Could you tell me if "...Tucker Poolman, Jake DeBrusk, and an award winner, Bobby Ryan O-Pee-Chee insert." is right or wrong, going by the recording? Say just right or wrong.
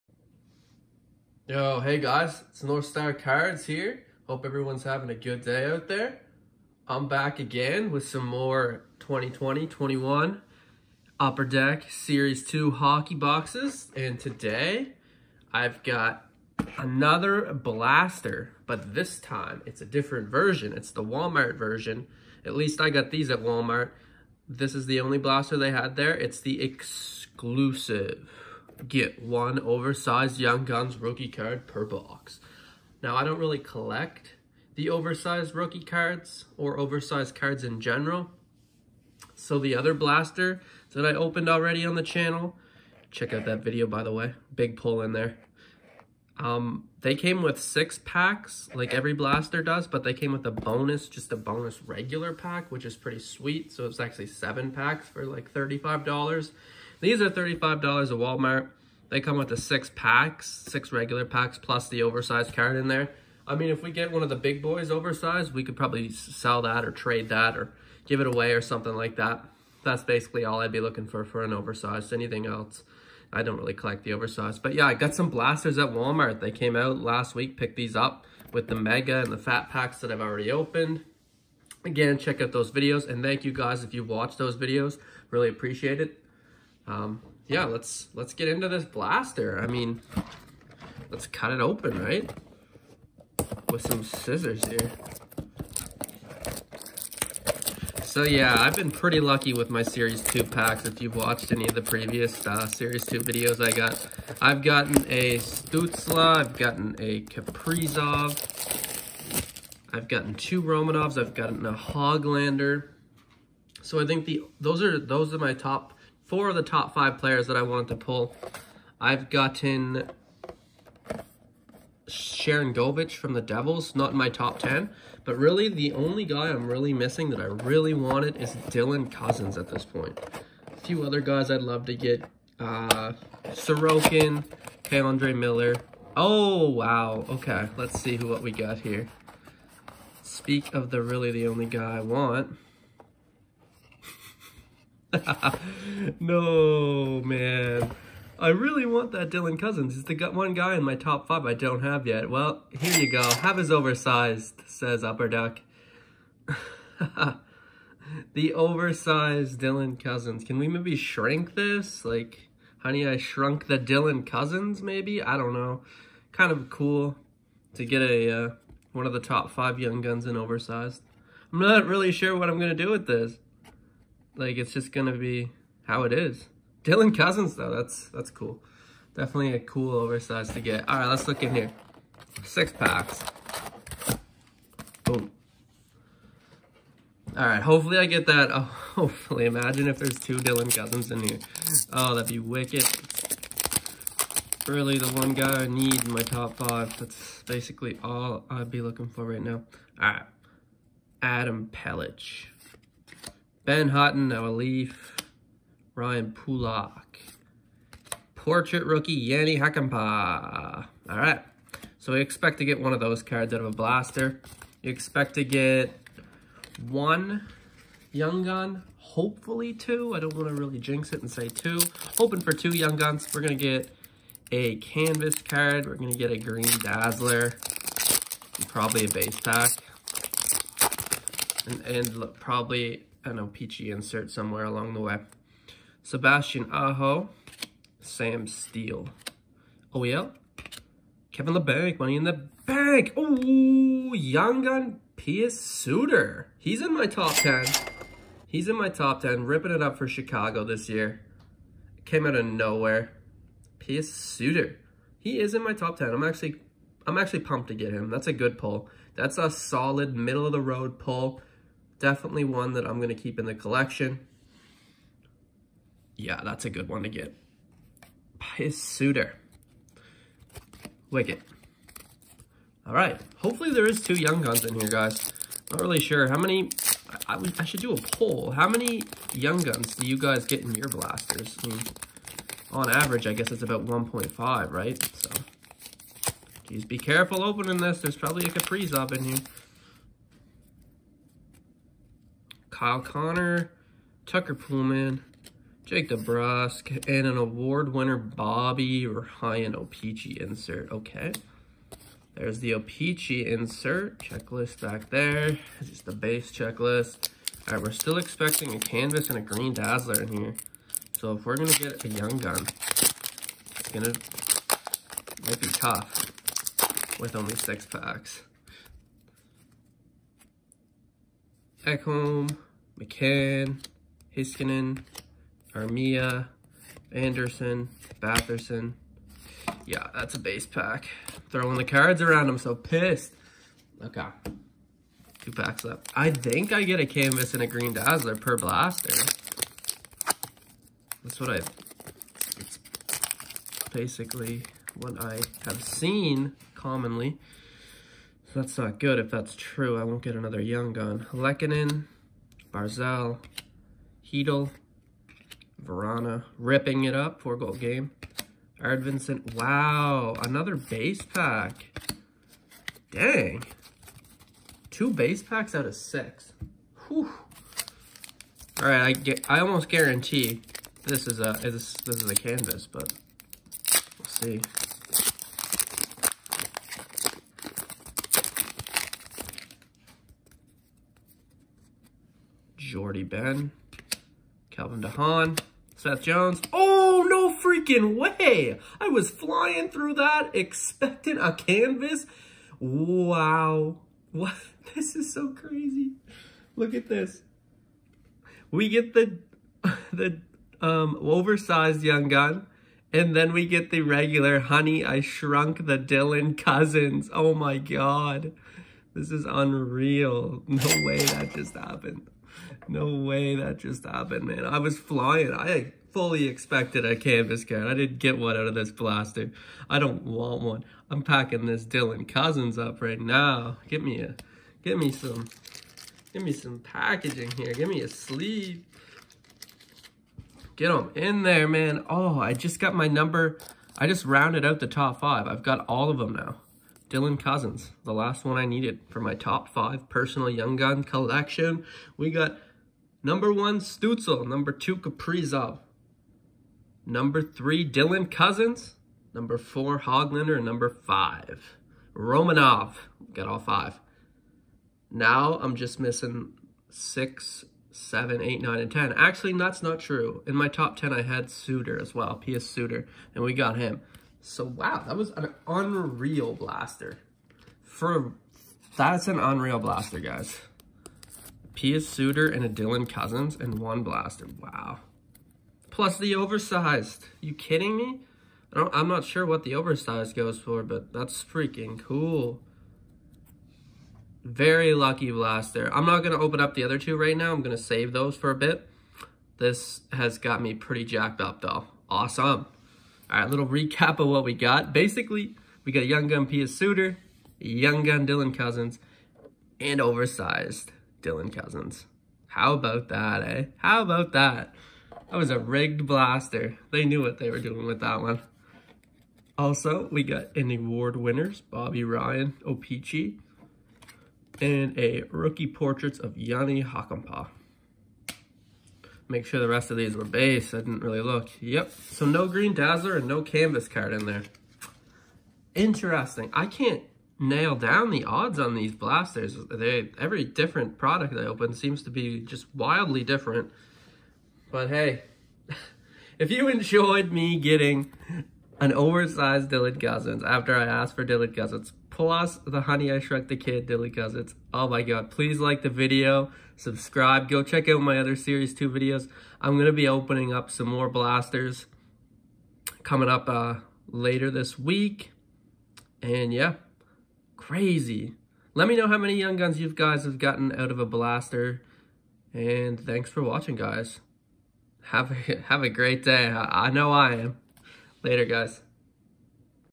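right.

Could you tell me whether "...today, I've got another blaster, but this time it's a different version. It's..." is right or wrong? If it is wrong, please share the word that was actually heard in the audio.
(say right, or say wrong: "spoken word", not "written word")
right.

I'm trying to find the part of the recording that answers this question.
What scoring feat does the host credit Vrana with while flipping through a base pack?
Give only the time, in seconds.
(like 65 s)
357 s.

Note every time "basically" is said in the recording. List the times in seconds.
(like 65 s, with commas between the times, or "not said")
70 s, 197 s, 343 s, 494 s.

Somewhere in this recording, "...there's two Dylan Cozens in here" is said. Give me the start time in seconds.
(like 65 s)
189 s.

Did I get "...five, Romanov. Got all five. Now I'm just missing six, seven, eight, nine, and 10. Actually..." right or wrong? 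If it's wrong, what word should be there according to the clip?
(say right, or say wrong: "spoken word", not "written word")
right.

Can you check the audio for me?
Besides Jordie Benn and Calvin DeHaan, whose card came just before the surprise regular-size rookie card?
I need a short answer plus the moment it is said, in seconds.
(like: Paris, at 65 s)
Seth Jones, at 385 s.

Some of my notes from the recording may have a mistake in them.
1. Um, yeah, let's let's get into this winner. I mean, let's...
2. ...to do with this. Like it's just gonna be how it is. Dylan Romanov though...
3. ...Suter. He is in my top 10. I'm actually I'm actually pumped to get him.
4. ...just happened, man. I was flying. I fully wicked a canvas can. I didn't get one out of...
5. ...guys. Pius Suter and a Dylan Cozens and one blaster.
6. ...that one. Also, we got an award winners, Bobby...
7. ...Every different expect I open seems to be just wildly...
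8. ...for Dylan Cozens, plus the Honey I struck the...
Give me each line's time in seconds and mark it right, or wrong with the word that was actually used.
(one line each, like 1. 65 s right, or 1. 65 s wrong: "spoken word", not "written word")
1. 86 s wrong: "blaster", not "winner"
2. 172 s wrong: "Cozens", not "Romanov"
3. 254 s right
4. 413 s wrong: "expected", not "wicked"
5. 470 s right
6. 508 s right
7. 530 s wrong: "product", not "expect"
8. 541 s right.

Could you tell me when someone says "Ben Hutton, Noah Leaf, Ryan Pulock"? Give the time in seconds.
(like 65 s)
203 s.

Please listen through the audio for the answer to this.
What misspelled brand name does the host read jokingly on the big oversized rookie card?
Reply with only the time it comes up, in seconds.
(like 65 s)
155 s.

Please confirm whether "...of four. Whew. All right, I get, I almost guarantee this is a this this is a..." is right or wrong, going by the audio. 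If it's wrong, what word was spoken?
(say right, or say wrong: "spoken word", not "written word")
wrong: "six", not "four".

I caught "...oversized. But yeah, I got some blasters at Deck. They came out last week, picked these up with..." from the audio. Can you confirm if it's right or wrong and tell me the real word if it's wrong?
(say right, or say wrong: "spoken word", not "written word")
wrong: "Walmart", not "Deck".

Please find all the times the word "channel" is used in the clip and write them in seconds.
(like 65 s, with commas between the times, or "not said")
42 s.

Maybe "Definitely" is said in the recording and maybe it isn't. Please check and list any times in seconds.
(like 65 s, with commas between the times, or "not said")
179 s, 262 s.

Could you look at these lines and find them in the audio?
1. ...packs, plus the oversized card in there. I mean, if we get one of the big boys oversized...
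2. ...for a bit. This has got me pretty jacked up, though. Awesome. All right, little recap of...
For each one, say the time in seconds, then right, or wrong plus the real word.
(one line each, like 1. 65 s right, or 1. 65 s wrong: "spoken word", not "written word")
1. 61 s right
2. 488 s right.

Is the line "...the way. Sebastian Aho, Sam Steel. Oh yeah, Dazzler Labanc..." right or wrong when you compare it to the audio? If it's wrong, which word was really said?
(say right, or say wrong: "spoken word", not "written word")
wrong: "Kevin", not "Dazzler".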